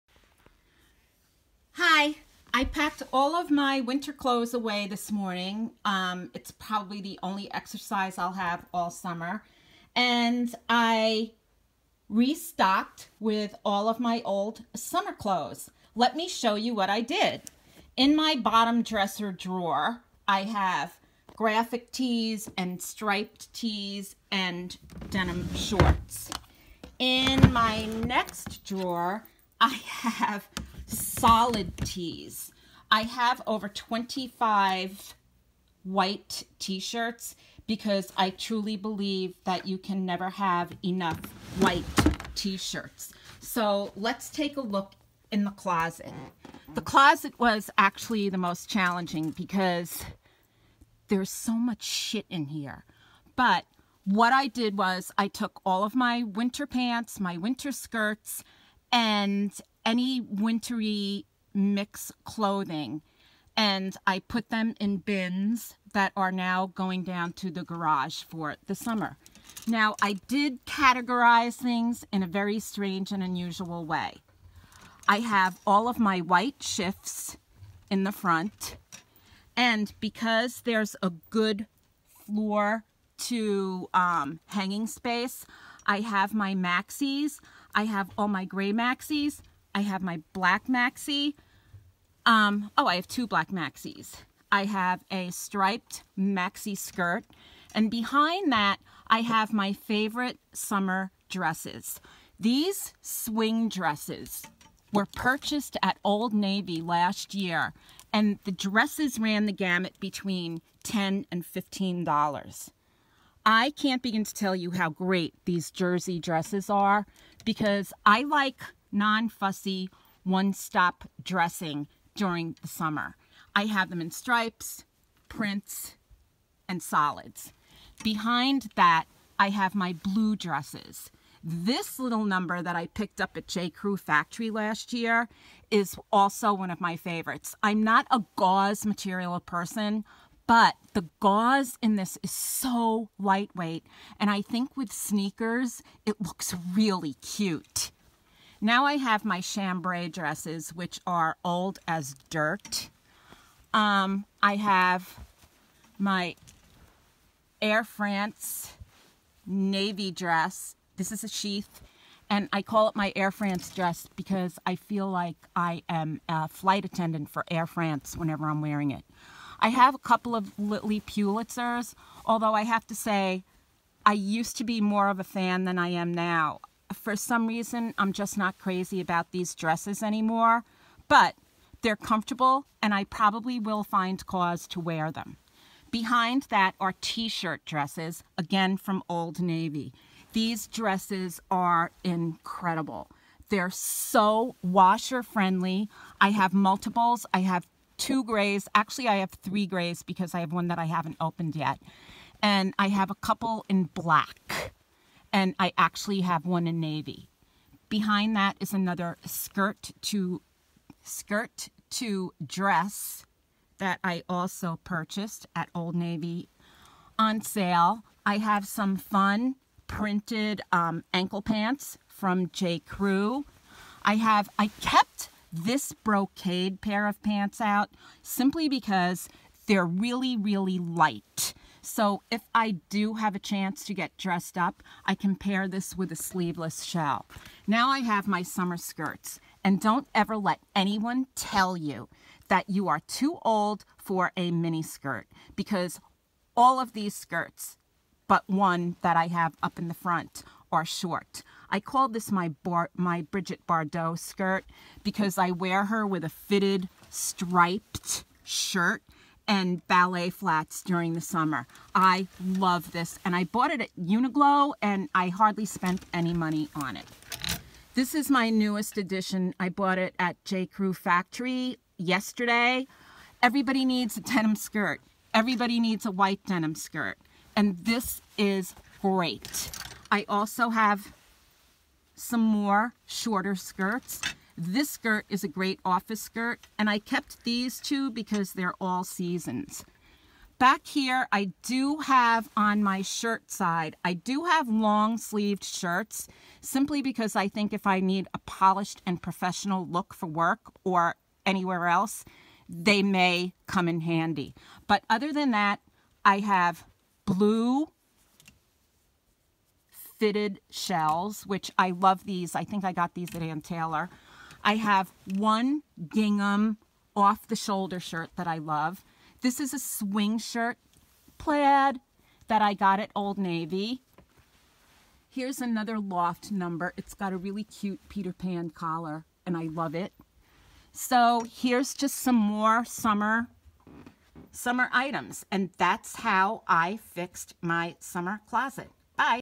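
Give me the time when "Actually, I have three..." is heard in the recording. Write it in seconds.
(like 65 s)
198 s.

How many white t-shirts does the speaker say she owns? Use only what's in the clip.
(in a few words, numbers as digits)
over 25.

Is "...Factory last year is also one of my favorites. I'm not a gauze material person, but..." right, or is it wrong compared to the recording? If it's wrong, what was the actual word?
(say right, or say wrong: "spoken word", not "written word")
right.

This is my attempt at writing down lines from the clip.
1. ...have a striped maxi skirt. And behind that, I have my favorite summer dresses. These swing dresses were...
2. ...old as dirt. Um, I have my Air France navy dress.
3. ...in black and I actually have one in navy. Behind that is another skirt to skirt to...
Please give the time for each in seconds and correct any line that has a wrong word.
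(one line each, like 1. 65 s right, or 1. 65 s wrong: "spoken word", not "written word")
1. 94 s right
2. 151 s right
3. 203 s right.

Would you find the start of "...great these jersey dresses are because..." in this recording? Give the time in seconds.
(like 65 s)
114 s.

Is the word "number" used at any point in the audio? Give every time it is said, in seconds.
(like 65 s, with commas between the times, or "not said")
132 s, 326 s.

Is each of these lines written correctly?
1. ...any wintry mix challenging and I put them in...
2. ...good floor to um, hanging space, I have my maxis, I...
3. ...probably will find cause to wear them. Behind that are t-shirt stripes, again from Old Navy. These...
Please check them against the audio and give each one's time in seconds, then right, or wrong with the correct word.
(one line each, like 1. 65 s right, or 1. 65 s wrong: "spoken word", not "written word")
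1. 59 s wrong: "clothing", not "challenging"
2. 81 s right
3. 183 s wrong: "dresses", not "stripes".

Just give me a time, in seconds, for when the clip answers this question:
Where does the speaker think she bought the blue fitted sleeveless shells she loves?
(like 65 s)
313 s.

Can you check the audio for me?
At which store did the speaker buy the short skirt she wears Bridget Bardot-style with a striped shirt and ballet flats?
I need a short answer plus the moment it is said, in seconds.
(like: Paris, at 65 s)
Uniqlo, at 263 s.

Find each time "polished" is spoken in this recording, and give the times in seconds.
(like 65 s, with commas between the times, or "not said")
298 s.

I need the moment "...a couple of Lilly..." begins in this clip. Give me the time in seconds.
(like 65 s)
169 s.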